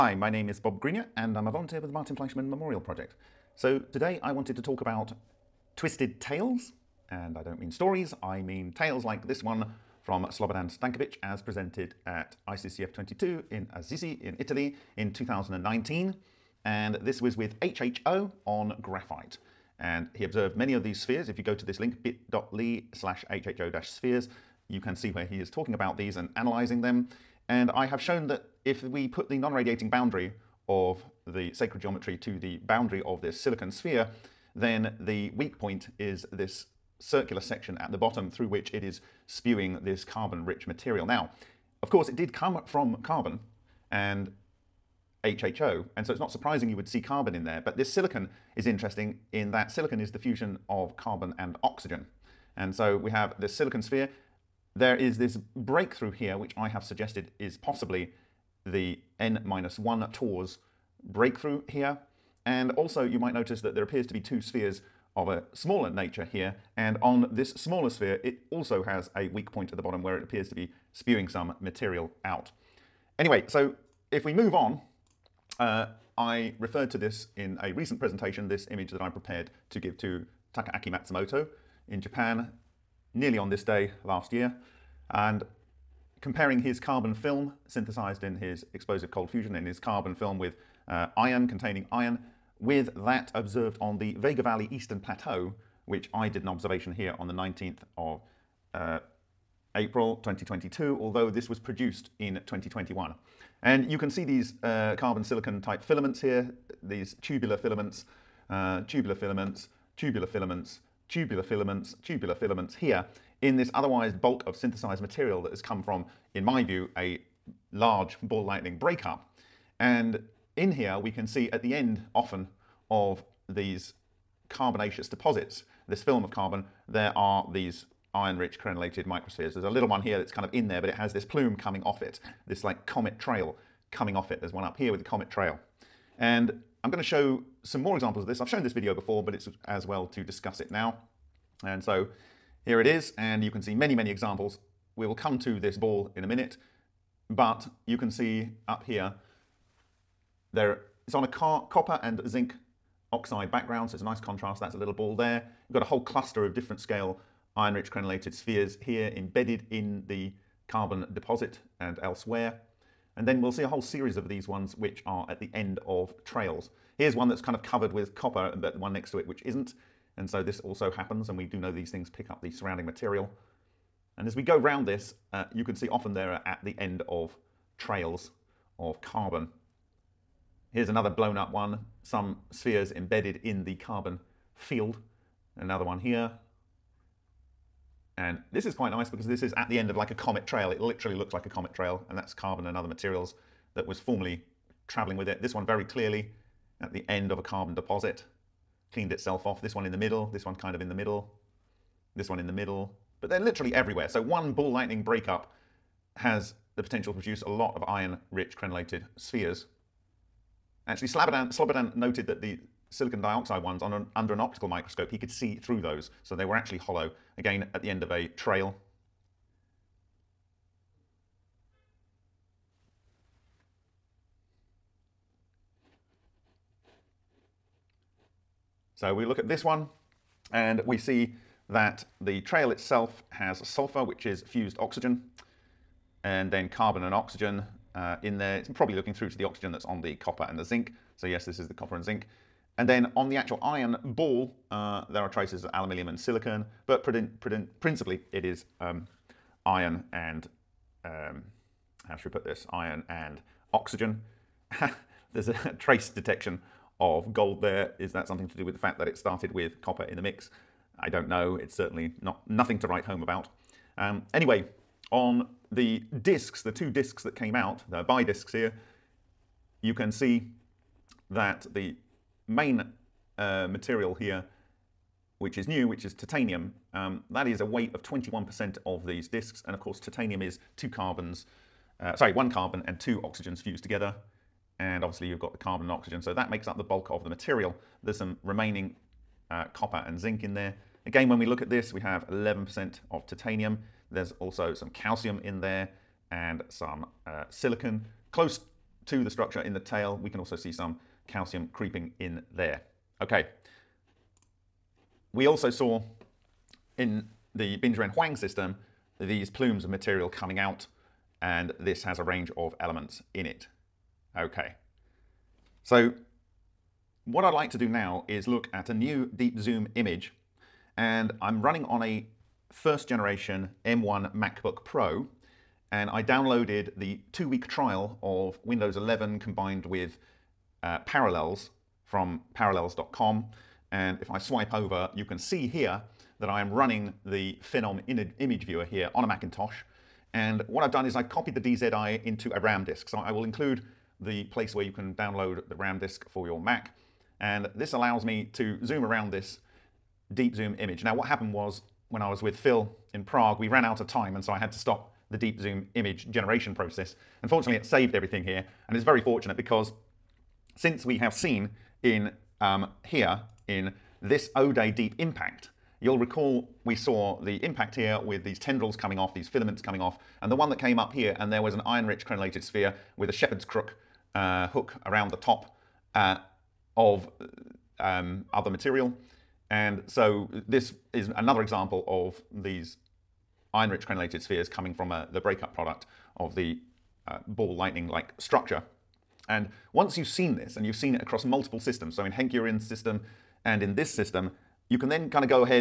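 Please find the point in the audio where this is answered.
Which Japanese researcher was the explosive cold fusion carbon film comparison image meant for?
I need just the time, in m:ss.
1:20.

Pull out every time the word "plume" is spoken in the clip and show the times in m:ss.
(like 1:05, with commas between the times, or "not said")
2:11, 5:09.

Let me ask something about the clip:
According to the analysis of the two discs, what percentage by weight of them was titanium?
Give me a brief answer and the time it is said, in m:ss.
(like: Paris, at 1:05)
21%, at 4:38.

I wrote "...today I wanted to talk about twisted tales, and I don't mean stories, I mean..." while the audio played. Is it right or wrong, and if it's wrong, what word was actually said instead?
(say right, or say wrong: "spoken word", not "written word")
right.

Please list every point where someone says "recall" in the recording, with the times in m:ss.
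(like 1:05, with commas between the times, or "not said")
6:06.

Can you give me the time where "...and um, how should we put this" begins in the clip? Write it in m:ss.
4:10.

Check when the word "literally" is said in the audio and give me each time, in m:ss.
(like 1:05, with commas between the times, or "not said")
3:10, 3:23.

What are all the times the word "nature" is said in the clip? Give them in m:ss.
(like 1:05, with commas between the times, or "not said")
1:05.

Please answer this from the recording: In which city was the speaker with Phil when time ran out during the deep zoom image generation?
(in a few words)
Prague.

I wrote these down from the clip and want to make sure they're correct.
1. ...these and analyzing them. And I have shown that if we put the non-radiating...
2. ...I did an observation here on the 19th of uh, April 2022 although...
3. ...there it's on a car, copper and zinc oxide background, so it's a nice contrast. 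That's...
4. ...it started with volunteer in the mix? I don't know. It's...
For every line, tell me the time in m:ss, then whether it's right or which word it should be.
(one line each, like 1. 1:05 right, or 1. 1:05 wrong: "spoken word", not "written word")
1. 0:25 right
2. 1:36 right
3. 2:30 right
4. 4:19 wrong: "copper", not "volunteer".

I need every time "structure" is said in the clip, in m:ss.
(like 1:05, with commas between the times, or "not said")
4:59, 6:28.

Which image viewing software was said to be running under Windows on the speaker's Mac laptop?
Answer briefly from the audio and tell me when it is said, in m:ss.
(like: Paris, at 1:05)
Phenom image viewer, at 5:37.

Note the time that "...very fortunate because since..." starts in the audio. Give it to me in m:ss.
5:59.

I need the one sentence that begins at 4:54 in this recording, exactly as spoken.
There's also some calcium in there and some uh, silicon.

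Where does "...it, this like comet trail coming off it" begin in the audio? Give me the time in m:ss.
2:12.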